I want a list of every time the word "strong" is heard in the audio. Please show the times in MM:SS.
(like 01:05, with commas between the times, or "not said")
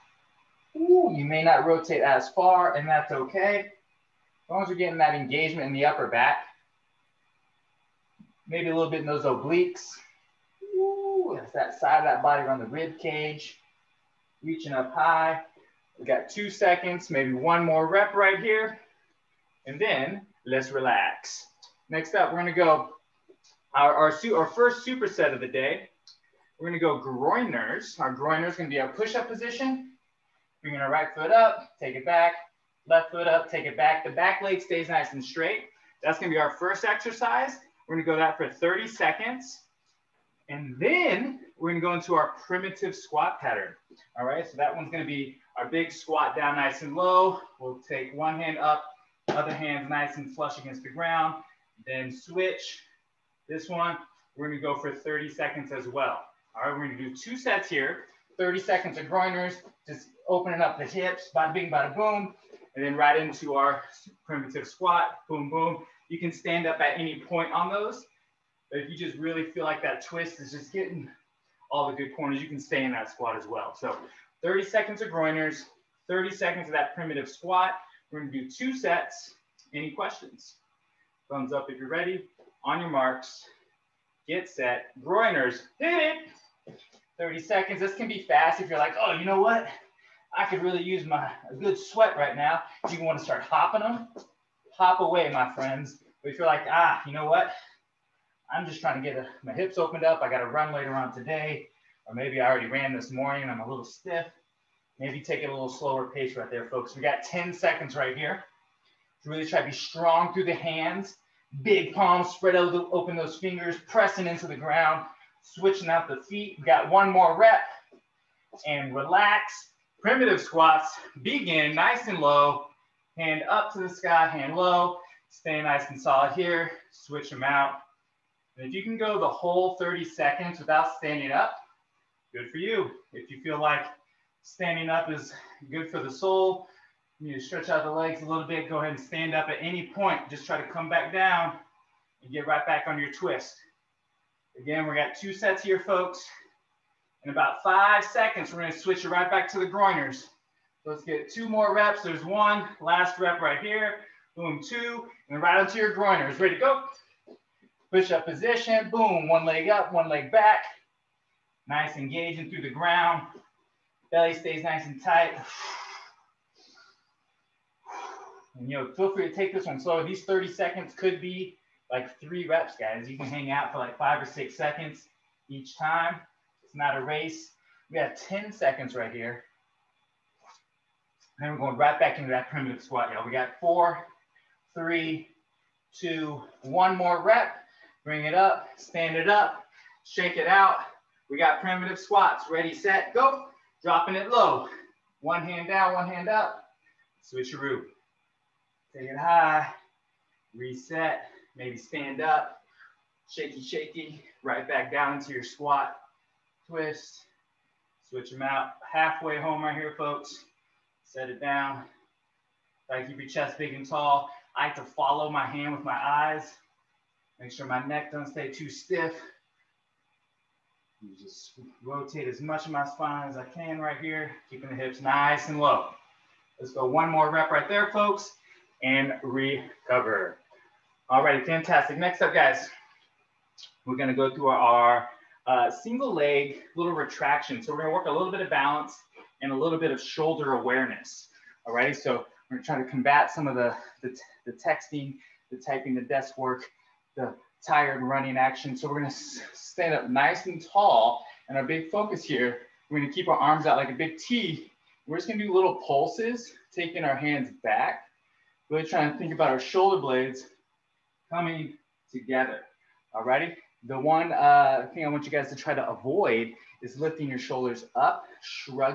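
01:49.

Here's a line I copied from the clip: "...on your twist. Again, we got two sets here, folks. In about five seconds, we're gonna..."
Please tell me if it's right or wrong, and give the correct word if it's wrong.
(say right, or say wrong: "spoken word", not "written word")
right.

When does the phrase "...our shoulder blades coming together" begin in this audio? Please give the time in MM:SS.
04:19.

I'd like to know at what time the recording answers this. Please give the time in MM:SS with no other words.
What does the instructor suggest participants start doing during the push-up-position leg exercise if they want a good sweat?
01:33.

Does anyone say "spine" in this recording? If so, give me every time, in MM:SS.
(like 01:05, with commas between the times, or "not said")
03:42.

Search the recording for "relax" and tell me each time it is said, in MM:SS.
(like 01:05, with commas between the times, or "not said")
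00:20, 01:58.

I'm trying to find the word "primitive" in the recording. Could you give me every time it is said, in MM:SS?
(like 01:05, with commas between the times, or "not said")
00:42, 01:04, 01:16, 02:00, 03:02, 03:11.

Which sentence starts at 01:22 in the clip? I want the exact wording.
On your marks, get set, groiners, hit it.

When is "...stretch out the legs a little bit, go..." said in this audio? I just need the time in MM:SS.
02:17.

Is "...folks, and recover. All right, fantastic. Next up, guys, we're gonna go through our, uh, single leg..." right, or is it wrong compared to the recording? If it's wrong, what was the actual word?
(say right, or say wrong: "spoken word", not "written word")
right.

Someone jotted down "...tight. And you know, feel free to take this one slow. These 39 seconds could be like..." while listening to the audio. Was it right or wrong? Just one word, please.
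wrong.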